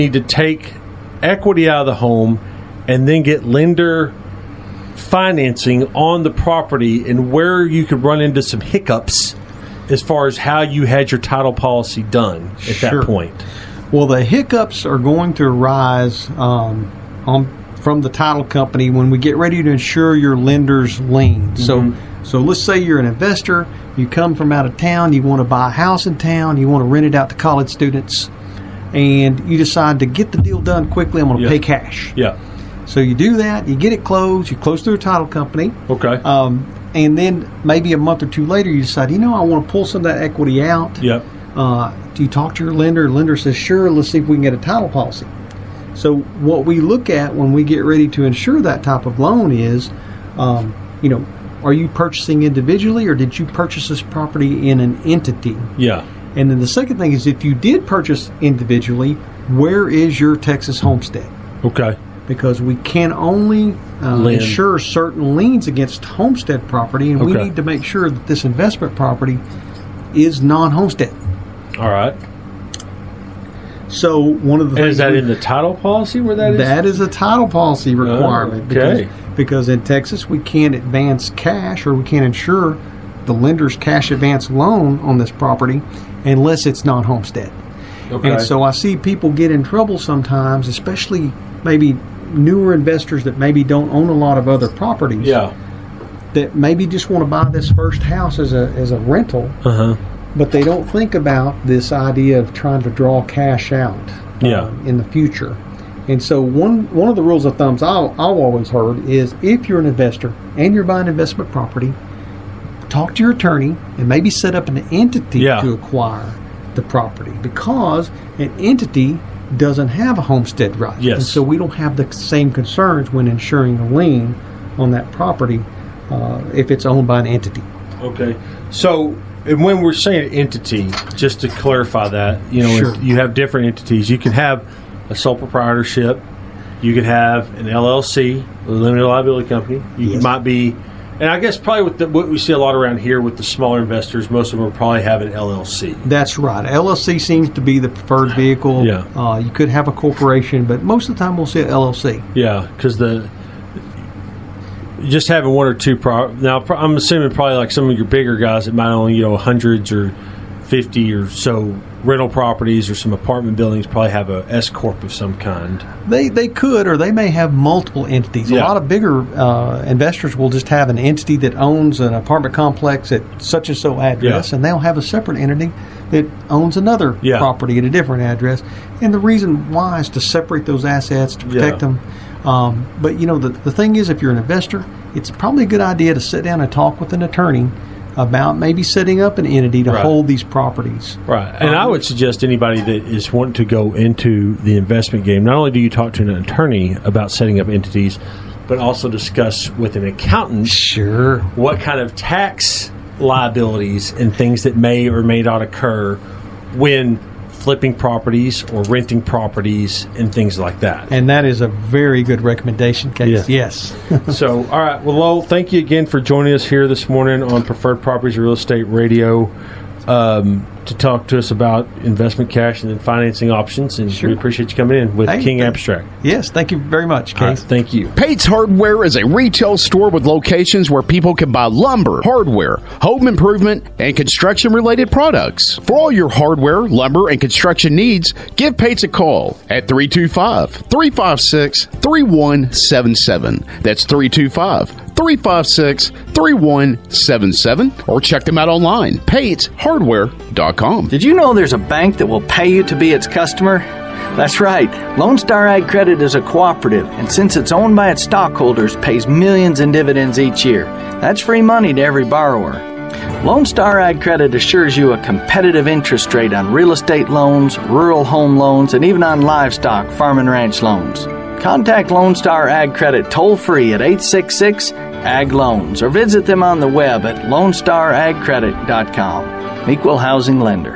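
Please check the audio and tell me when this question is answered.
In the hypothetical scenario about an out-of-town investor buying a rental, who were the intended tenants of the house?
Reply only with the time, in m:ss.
0:27.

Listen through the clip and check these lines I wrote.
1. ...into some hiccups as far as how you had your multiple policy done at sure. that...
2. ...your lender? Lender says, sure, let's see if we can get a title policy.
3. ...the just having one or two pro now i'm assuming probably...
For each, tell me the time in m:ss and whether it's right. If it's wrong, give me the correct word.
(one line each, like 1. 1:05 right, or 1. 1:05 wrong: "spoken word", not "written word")
1. 0:08 wrong: "title", not "multiple"
2. 0:42 right
3. 2:32 right.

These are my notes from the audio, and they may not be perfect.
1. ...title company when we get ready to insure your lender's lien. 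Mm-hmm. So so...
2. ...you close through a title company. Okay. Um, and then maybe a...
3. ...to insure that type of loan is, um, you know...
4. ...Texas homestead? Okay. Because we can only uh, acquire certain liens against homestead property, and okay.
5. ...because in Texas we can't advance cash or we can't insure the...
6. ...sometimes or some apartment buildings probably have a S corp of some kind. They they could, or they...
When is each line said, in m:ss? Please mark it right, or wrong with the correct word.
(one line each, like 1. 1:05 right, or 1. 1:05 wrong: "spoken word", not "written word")
1. 0:18 right
2. 0:34 right
3. 0:48 right
4. 1:00 wrong: "insure", not "acquire"
5. 1:19 right
6. 2:42 wrong: "properties", not "sometimes".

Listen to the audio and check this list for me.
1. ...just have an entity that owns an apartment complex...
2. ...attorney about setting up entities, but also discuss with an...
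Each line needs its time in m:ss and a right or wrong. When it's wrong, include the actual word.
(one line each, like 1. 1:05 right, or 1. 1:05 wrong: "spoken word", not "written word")
1. 2:50 right
2. 3:16 right.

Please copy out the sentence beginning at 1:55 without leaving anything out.
to acquire the property because an entity doesn't have a homestead right.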